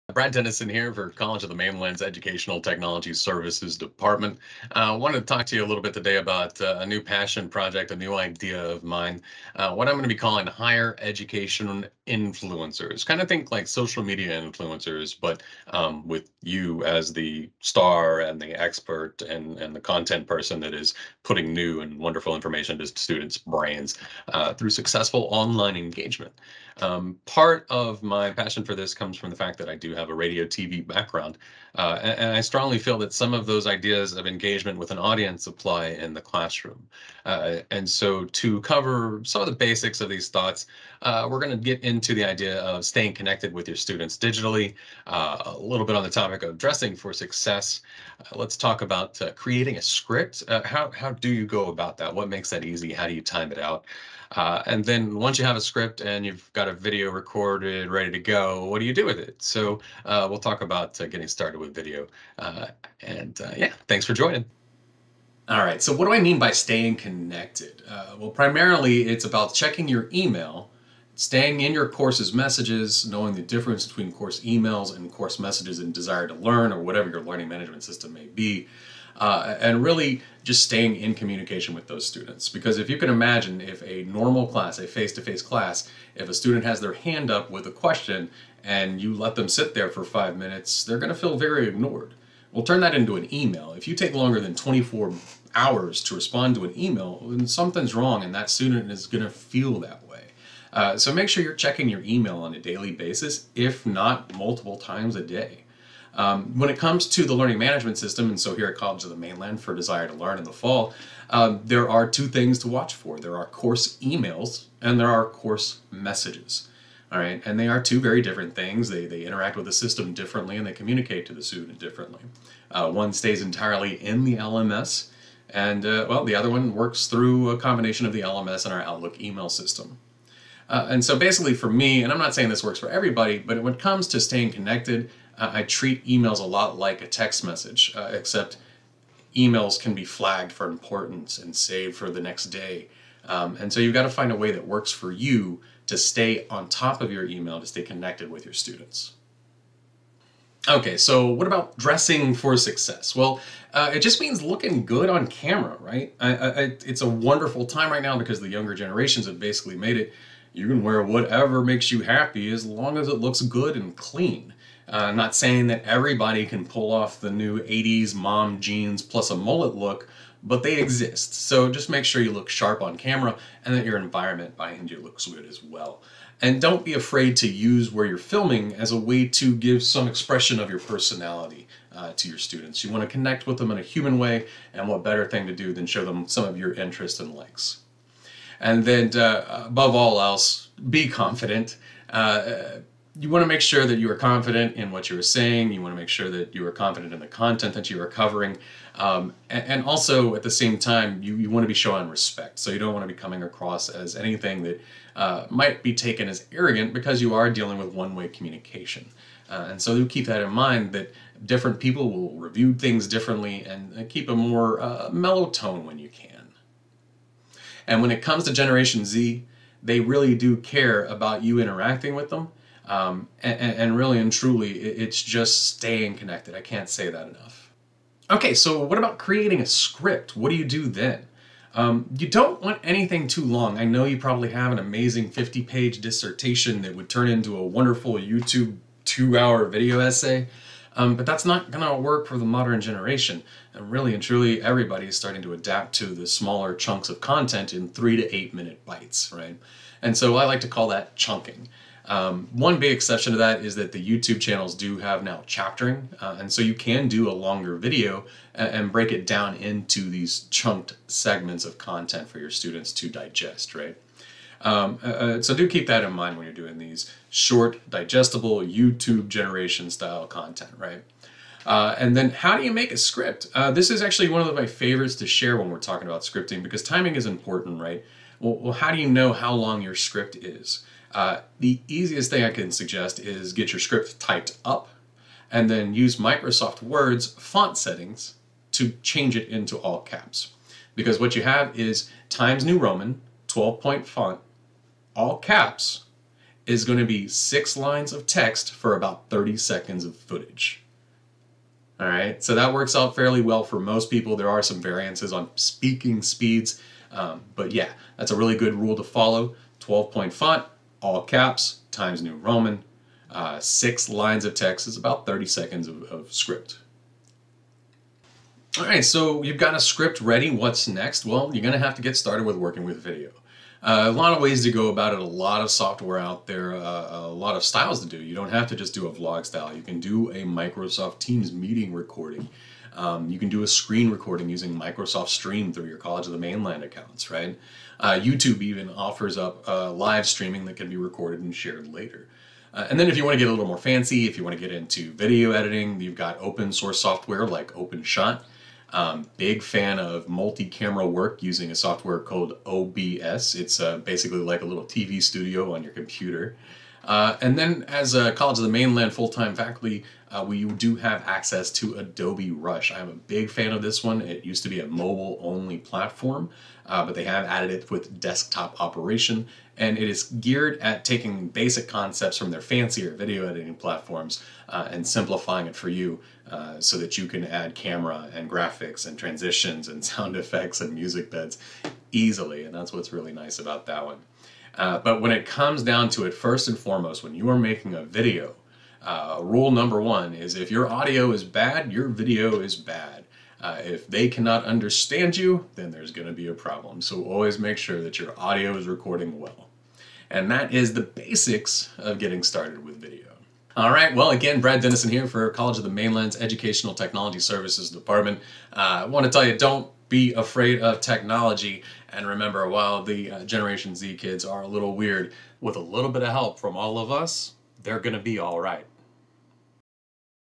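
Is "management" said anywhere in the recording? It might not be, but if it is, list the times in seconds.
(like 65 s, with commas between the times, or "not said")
77 s, 107 s.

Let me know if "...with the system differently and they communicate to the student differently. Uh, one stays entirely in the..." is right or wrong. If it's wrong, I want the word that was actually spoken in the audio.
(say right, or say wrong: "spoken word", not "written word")
right.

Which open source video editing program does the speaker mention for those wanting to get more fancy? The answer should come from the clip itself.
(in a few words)
OpenShot.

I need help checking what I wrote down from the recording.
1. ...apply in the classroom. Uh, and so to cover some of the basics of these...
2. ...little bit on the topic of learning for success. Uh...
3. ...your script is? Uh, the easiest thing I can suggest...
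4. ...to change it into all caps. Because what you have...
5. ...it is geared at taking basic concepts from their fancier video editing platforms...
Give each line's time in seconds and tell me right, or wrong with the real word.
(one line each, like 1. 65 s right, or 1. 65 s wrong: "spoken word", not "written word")
1. 35 s right
2. 45 s wrong: "dressing", not "learning"
3. 279 s right
4. 288 s right
5. 369 s right.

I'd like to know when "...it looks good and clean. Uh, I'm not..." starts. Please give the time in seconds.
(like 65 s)
163 s.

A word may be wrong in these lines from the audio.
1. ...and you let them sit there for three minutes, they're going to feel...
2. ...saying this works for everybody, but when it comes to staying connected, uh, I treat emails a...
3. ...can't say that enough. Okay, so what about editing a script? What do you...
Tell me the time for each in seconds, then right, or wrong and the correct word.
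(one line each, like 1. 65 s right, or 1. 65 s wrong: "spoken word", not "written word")
1. 88 s wrong: "five", not "three"
2. 132 s right
3. 226 s wrong: "creating", not "editing".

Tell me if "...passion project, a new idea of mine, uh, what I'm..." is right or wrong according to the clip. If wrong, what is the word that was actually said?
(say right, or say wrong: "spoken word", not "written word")
right.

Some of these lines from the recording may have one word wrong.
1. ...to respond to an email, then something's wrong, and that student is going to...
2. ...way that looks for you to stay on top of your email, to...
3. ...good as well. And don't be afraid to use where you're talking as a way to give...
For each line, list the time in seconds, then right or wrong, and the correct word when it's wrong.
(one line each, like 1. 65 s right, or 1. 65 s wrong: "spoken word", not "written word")
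1. 96 s right
2. 144 s wrong: "works", not "looks"
3. 175 s wrong: "filming", not "talking".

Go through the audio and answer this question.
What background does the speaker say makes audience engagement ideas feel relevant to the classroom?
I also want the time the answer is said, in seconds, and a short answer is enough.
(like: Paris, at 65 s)
radio TV, at 30 s.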